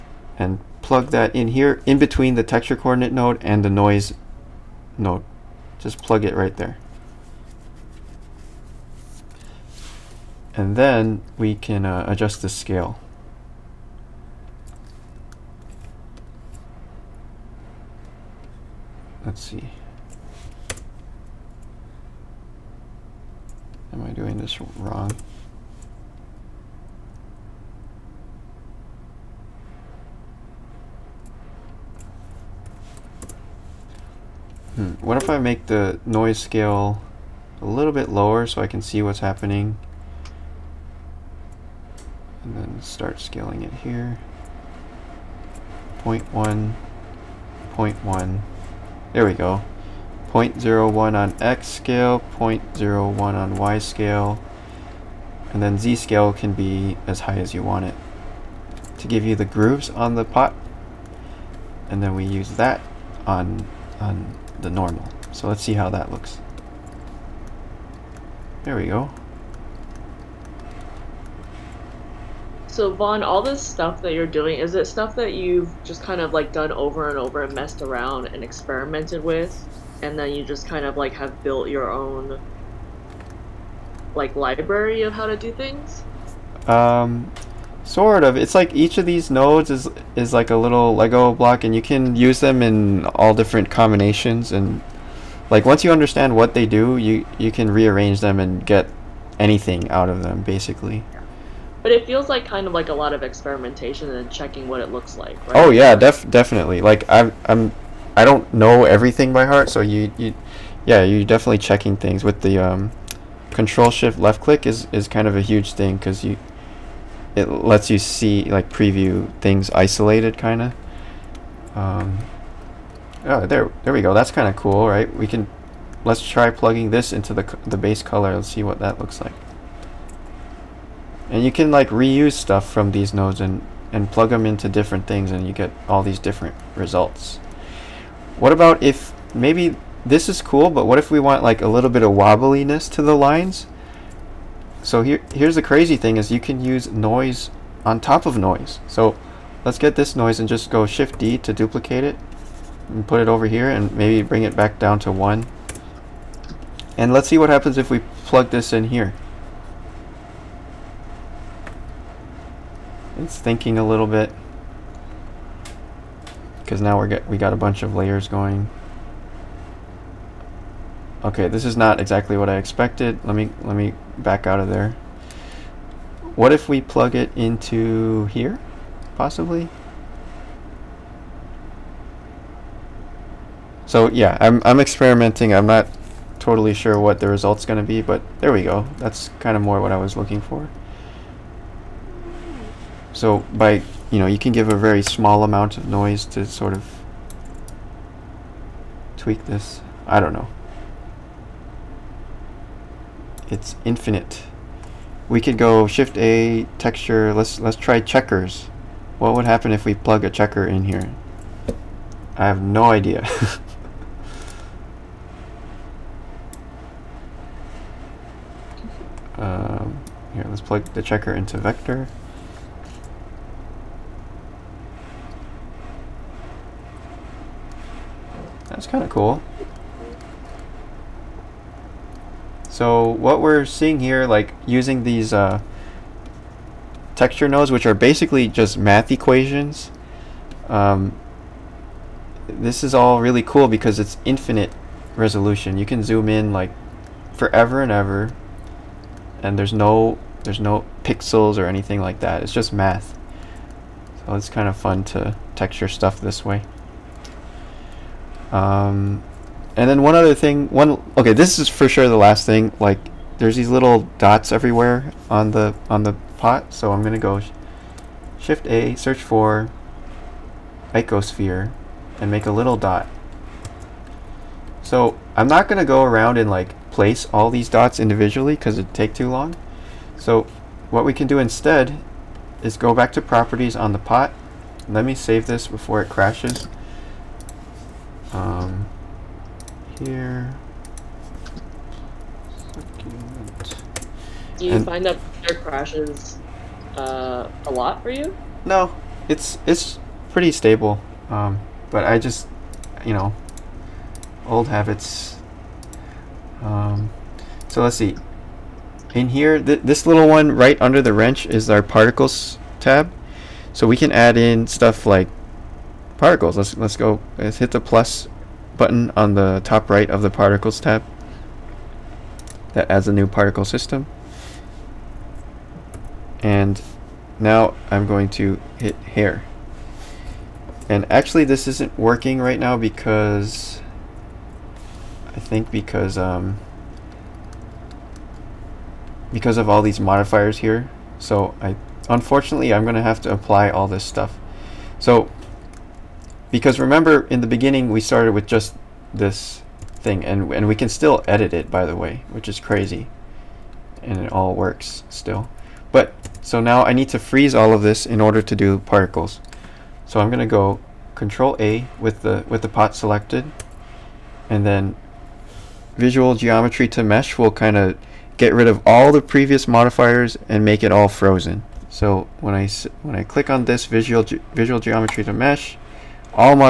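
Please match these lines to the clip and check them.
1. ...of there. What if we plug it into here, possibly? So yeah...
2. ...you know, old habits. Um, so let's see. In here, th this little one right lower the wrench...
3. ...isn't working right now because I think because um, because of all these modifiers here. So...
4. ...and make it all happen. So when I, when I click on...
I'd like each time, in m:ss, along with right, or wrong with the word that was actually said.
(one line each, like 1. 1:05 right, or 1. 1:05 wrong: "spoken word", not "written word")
1. 2:54 right
2. 5:03 wrong: "under", not "lower"
3. 5:31 right
4. 6:10 wrong: "frozen", not "happen".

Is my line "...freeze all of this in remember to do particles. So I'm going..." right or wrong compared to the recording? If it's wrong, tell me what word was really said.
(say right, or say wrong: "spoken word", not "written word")
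wrong: "order", not "remember".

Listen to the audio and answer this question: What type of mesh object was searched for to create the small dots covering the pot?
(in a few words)
Icosphere.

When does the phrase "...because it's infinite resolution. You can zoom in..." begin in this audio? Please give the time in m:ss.
4:03.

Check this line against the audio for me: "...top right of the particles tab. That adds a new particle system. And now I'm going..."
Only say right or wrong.
right.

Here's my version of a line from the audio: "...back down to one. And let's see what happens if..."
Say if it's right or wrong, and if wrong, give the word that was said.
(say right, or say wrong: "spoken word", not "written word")
right.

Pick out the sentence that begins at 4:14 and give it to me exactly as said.
So it's kind of fun to texture stuff this way.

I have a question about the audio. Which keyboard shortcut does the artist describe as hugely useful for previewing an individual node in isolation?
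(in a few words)
Control Shift left click.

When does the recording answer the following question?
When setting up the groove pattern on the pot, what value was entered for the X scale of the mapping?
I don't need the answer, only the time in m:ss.
0:50.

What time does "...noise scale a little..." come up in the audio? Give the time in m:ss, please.
0:36.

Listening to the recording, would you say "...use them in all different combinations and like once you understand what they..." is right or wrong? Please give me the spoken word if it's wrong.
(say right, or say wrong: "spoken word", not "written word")
right.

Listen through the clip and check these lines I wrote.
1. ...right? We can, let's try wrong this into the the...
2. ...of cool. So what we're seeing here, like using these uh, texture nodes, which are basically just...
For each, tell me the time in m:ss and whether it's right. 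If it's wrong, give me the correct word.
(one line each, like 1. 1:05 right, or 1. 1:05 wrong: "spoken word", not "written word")
1. 2:04 wrong: "plugging", not "wrong"
2. 3:49 right.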